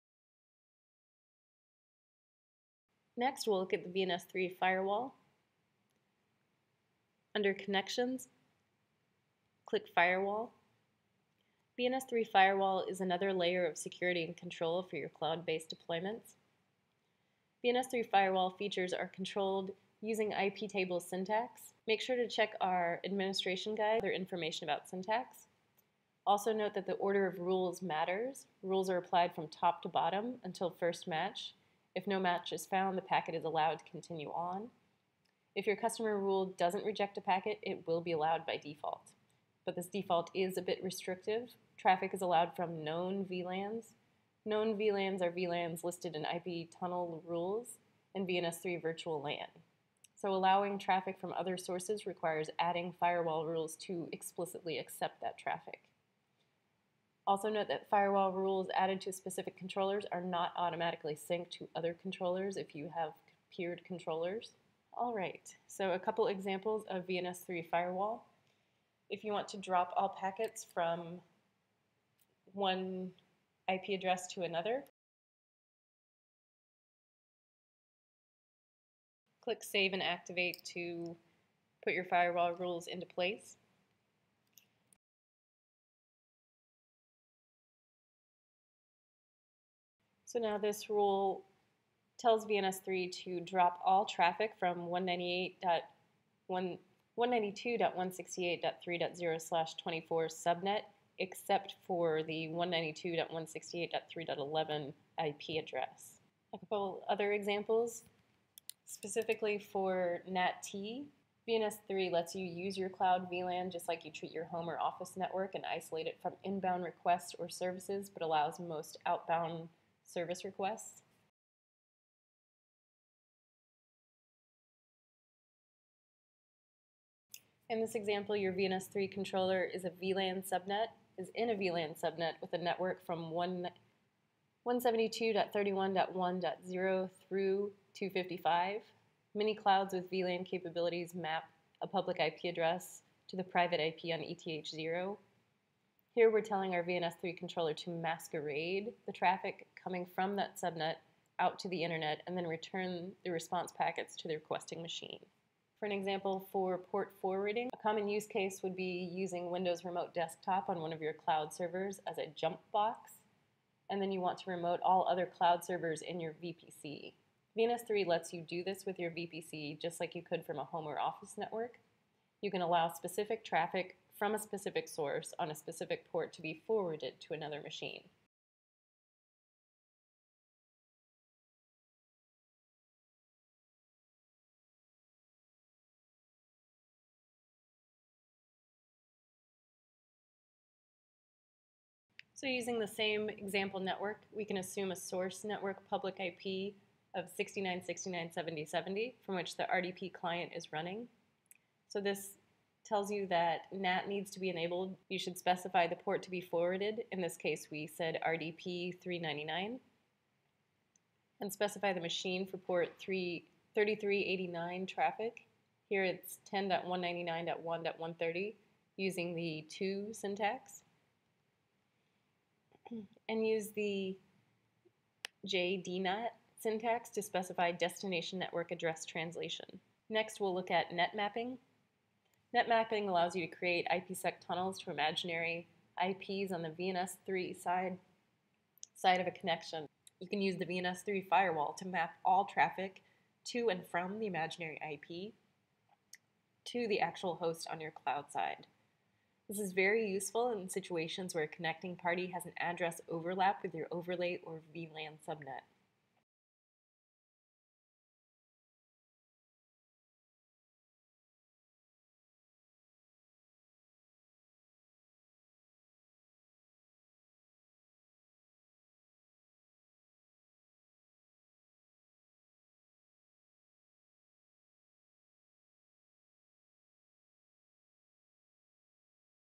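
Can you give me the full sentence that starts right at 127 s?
In this example, your VNS3 controller is a VLAN subnet, is in a VLAN subnet with a network from 172.31.1.0 through 255.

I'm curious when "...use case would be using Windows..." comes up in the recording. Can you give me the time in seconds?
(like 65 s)
158 s.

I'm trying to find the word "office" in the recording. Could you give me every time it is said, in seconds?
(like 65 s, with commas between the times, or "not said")
114 s, 170 s.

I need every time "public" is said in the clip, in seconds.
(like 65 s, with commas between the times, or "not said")
141 s, 195 s.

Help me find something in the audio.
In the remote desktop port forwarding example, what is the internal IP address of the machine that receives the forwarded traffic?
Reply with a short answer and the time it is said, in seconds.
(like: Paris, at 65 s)
10.199.1.130, at 216 s.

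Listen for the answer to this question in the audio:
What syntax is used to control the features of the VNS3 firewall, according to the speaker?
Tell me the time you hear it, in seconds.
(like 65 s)
20 s.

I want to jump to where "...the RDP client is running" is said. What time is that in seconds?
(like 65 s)
199 s.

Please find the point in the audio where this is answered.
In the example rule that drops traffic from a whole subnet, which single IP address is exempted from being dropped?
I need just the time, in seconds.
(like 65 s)
102 s.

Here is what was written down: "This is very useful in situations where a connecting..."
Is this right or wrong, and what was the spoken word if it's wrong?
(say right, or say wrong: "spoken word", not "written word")
right.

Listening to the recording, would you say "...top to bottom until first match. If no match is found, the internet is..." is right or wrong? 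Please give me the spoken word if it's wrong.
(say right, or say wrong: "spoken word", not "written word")
wrong: "packet", not "internet".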